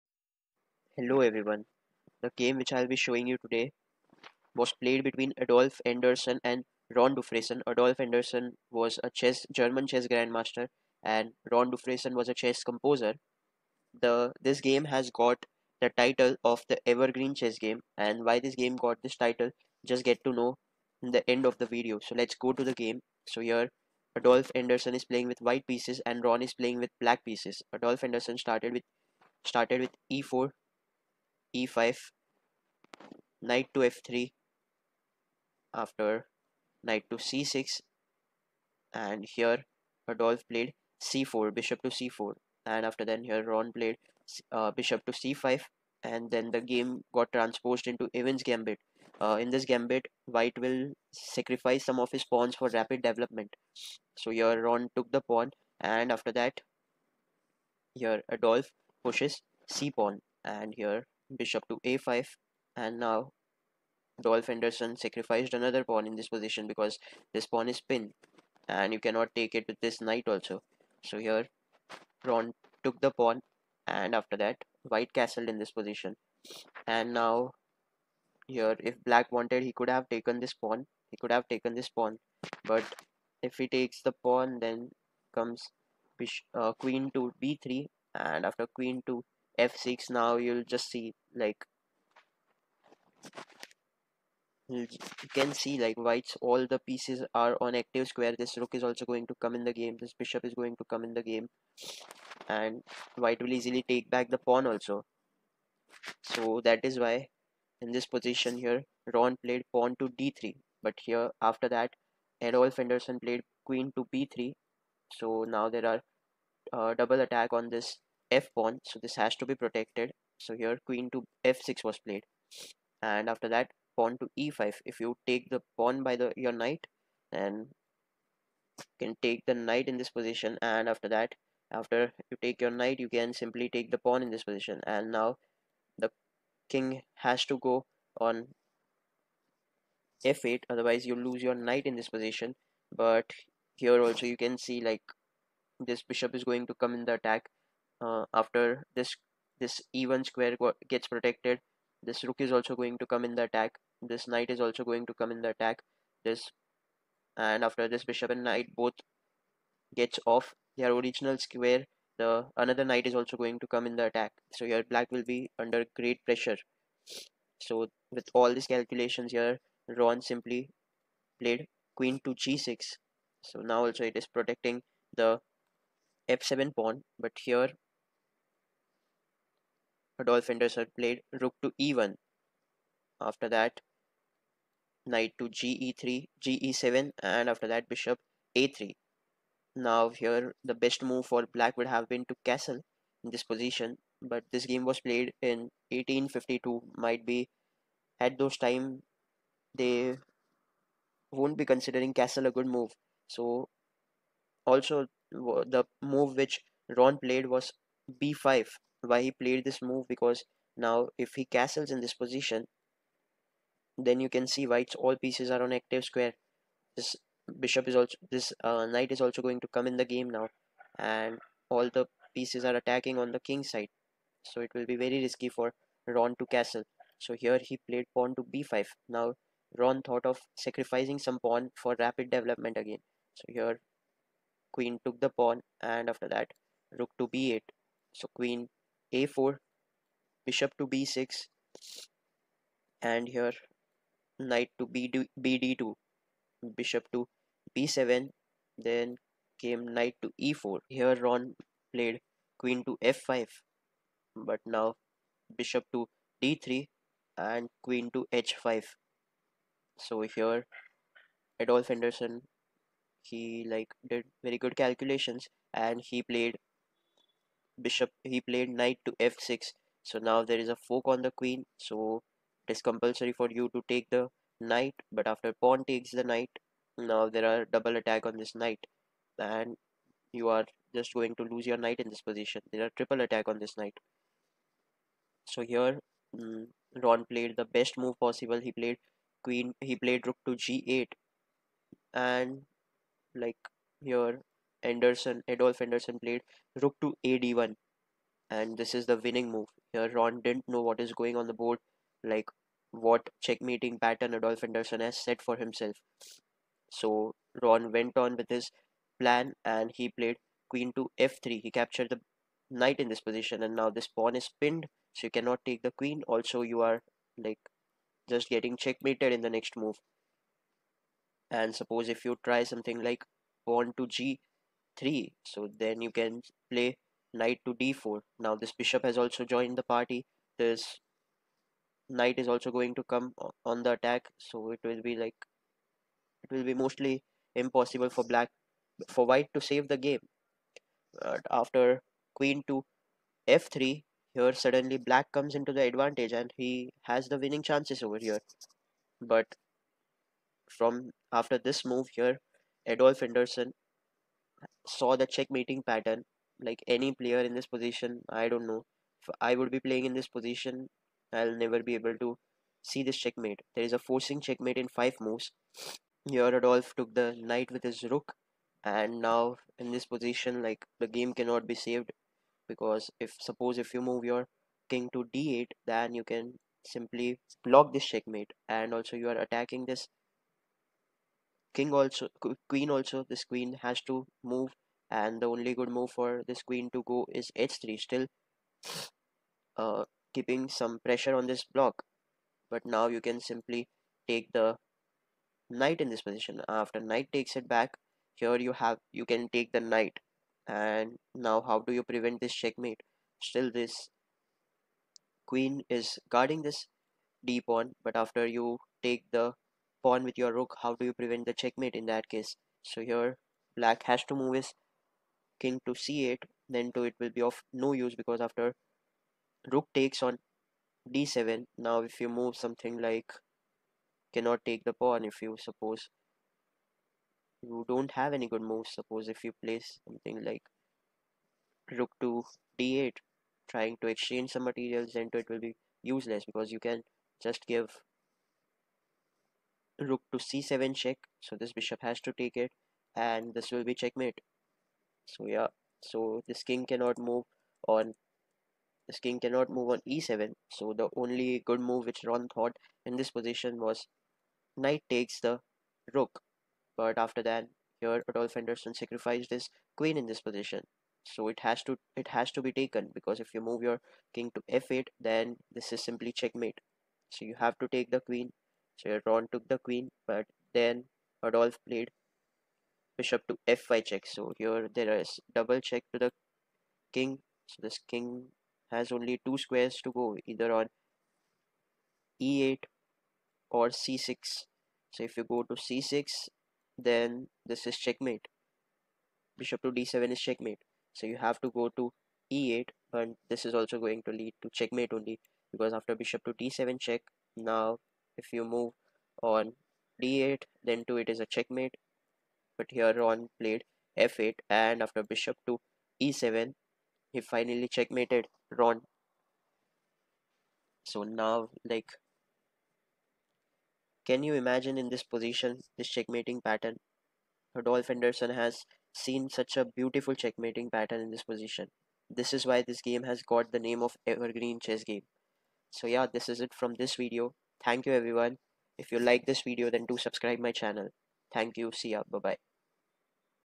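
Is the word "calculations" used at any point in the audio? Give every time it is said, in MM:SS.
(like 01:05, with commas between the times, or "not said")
02:48, 04:24.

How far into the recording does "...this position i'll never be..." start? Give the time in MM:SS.
06:00.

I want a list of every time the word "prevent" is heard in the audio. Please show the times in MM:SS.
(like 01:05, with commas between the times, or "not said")
06:42, 06:51.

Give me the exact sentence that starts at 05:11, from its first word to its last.
He captured the knight in this position and now this pawn is pinned so you cannot take the queen.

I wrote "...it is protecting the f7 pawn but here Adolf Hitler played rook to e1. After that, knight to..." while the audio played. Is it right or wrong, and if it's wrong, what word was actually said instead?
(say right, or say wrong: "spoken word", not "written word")
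right.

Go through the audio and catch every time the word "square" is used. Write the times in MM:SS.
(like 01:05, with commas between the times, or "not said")
01:38, 02:30, 02:41, 03:36, 07:59.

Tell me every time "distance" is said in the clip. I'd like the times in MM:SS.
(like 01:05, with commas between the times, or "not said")
not said.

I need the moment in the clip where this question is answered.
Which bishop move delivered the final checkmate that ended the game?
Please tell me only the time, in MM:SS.
08:25.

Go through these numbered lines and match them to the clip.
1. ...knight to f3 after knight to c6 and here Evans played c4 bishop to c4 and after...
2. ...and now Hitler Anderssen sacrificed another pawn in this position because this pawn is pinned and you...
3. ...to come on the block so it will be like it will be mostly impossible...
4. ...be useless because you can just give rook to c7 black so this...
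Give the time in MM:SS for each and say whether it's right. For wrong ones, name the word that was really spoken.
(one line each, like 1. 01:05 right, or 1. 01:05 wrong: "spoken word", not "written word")
1. 00:33 wrong: "Adolf", not "Evans"
2. 01:02 wrong: "Dolph", not "Hitler"
3. 05:32 wrong: "attack", not "block"
4. 07:15 wrong: "check", not "black".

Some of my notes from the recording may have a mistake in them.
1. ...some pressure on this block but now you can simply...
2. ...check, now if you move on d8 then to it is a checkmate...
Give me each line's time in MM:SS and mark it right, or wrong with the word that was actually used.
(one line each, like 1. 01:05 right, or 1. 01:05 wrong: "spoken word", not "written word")
1. 06:30 right
2. 08:16 right.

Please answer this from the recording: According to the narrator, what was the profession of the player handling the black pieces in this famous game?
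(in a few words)
Chess composer.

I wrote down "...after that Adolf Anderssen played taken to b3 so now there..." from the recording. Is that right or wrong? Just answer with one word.
wrong.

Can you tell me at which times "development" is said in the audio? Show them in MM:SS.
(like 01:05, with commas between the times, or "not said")
00:53, 03:52.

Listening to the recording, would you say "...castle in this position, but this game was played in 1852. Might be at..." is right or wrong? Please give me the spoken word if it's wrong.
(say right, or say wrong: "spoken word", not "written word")
right.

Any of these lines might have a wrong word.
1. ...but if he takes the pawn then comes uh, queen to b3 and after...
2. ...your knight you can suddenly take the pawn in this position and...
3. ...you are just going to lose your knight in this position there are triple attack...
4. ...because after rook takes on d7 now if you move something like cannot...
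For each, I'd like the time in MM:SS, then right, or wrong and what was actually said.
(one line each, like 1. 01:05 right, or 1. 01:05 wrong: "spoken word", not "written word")
1. 01:22 right
2. 02:12 wrong: "simply", not "suddenly"
3. 04:40 right
4. 06:58 right.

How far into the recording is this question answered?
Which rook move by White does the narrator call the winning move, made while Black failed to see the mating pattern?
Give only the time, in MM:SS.
04:56.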